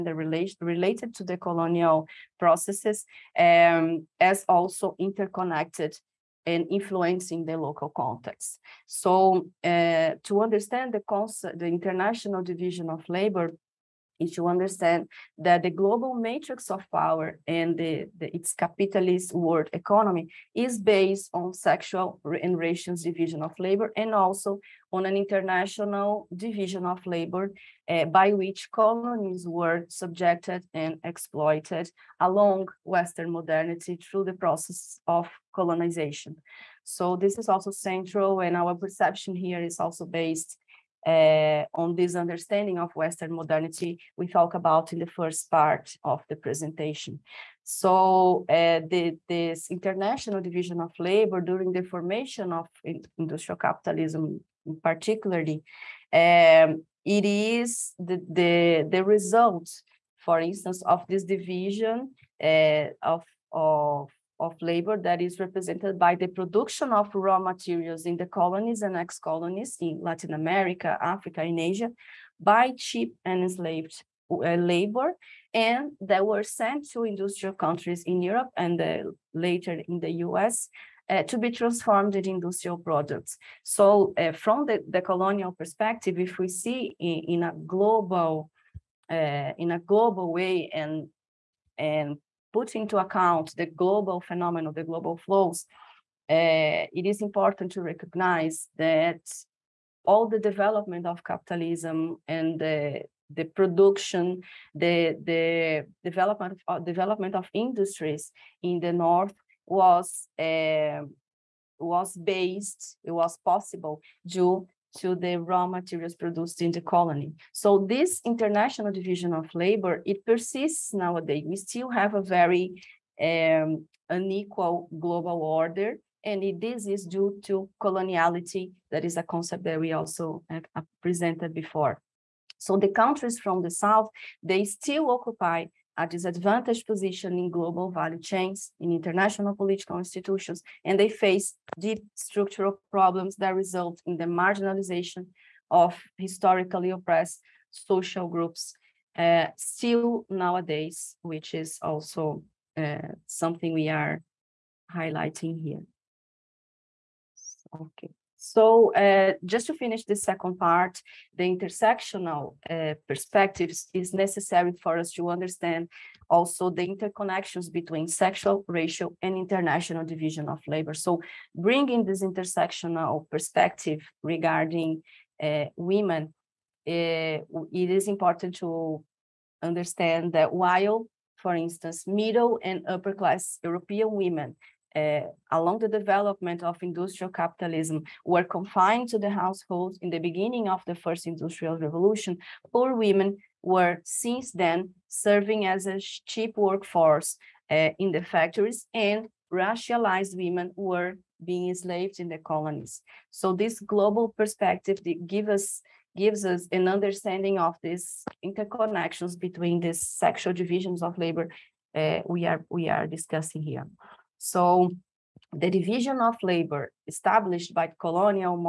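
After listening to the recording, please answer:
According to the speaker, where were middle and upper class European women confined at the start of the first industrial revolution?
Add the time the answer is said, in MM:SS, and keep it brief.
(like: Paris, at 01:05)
the households, at 03:09.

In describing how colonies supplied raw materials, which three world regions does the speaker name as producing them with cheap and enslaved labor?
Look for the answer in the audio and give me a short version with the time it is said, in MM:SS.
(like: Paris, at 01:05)
Latin America, Africa, and Asia, at 01:10.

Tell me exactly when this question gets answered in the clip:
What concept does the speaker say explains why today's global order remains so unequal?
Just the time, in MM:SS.
02:07.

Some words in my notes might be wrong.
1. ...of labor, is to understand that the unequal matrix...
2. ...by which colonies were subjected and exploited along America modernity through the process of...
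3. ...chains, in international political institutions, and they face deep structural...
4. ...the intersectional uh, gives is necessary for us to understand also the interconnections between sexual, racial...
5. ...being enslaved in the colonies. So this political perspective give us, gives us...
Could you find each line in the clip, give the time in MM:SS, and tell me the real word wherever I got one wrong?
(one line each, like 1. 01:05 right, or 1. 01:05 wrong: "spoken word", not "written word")
1. 00:12 wrong: "global", not "unequal"
2. 00:28 wrong: "Western", not "America"
3. 02:18 right
4. 02:41 wrong: "perspectives", not "gives"
5. 03:21 wrong: "global", not "political".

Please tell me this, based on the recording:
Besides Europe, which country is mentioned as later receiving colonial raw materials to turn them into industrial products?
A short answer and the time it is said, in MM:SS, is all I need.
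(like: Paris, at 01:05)
the US, at 01:19.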